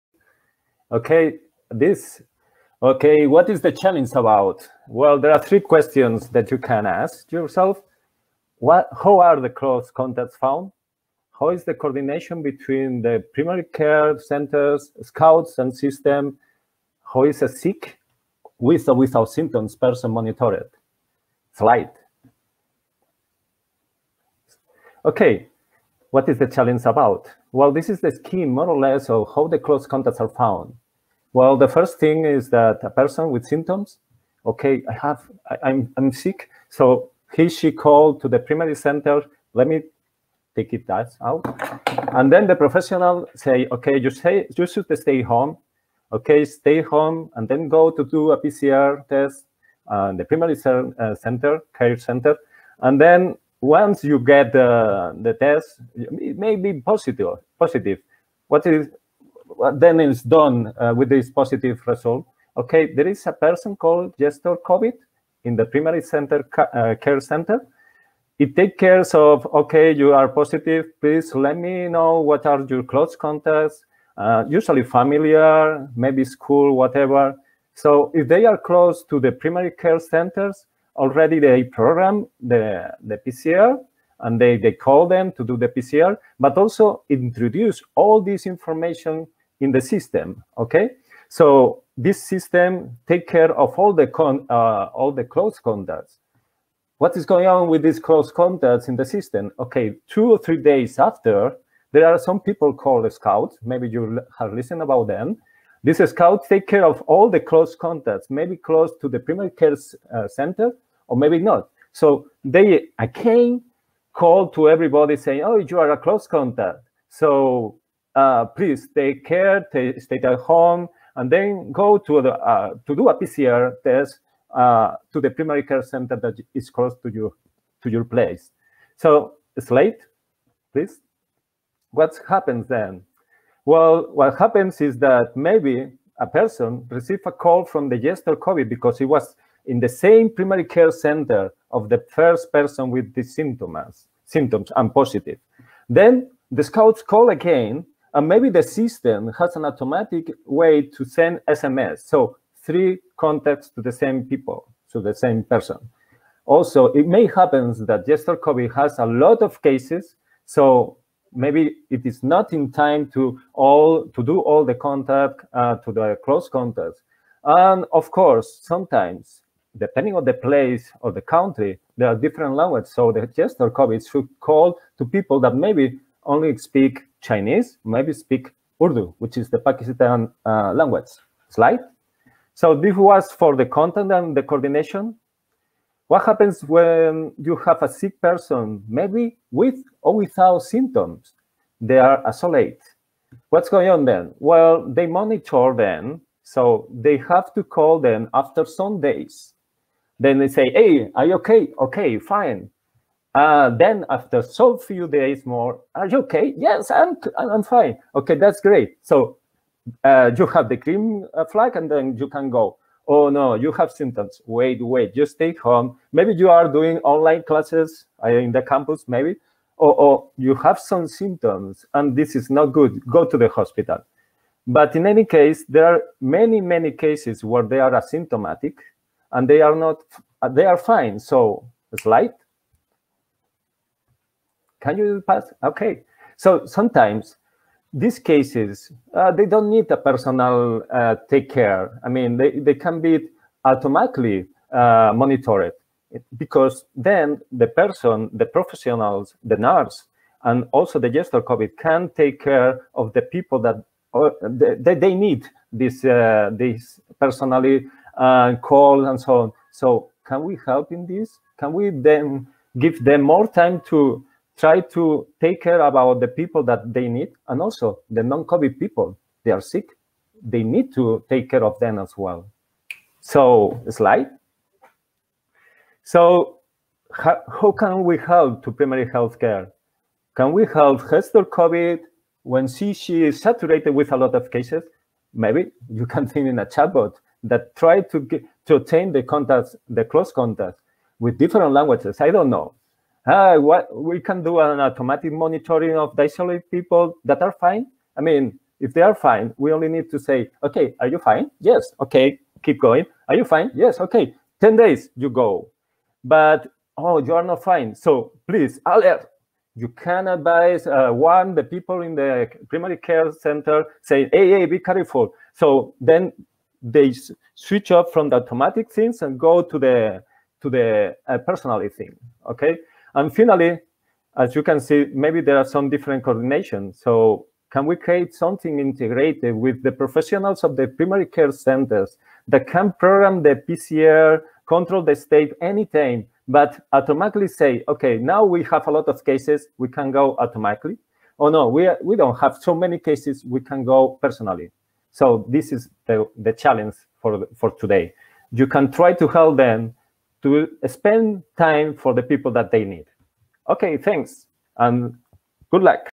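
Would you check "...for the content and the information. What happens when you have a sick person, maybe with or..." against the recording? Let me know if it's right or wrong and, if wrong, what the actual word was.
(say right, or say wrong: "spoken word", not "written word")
wrong: "coordination", not "information".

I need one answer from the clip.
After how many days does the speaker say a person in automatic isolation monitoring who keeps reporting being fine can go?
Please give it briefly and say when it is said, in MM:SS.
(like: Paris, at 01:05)
10, at 05:04.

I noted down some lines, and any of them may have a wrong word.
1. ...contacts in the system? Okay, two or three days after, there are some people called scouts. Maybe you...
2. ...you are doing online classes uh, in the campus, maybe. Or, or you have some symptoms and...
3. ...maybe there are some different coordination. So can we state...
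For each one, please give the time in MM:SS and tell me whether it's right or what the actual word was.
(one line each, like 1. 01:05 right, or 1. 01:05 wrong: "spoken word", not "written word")
1. 01:38 right
2. 03:36 right
3. 05:25 wrong: "create", not "state".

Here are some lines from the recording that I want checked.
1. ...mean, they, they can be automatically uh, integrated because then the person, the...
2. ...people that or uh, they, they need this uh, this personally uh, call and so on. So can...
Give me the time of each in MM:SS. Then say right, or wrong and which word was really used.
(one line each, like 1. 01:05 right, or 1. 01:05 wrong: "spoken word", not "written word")
1. 04:02 wrong: "monitored", not "integrated"
2. 04:13 right.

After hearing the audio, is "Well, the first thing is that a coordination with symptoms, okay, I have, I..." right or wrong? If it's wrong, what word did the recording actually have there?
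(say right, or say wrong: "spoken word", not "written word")
wrong: "person", not "coordination".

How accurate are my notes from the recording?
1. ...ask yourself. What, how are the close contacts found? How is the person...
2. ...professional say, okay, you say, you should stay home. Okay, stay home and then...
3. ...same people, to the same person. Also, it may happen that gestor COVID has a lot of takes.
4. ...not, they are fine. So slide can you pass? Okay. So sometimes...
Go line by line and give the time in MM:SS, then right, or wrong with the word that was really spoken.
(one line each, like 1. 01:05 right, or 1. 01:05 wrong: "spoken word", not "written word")
1. 00:06 wrong: "coordination", not "person"
2. 00:42 right
3. 02:33 wrong: "cases", not "takes"
4. 03:49 right.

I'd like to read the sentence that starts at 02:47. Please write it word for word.
And of course, sometimes, depending on the place or the country, there are different languages.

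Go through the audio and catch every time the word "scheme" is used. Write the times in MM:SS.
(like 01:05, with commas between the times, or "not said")
00:28.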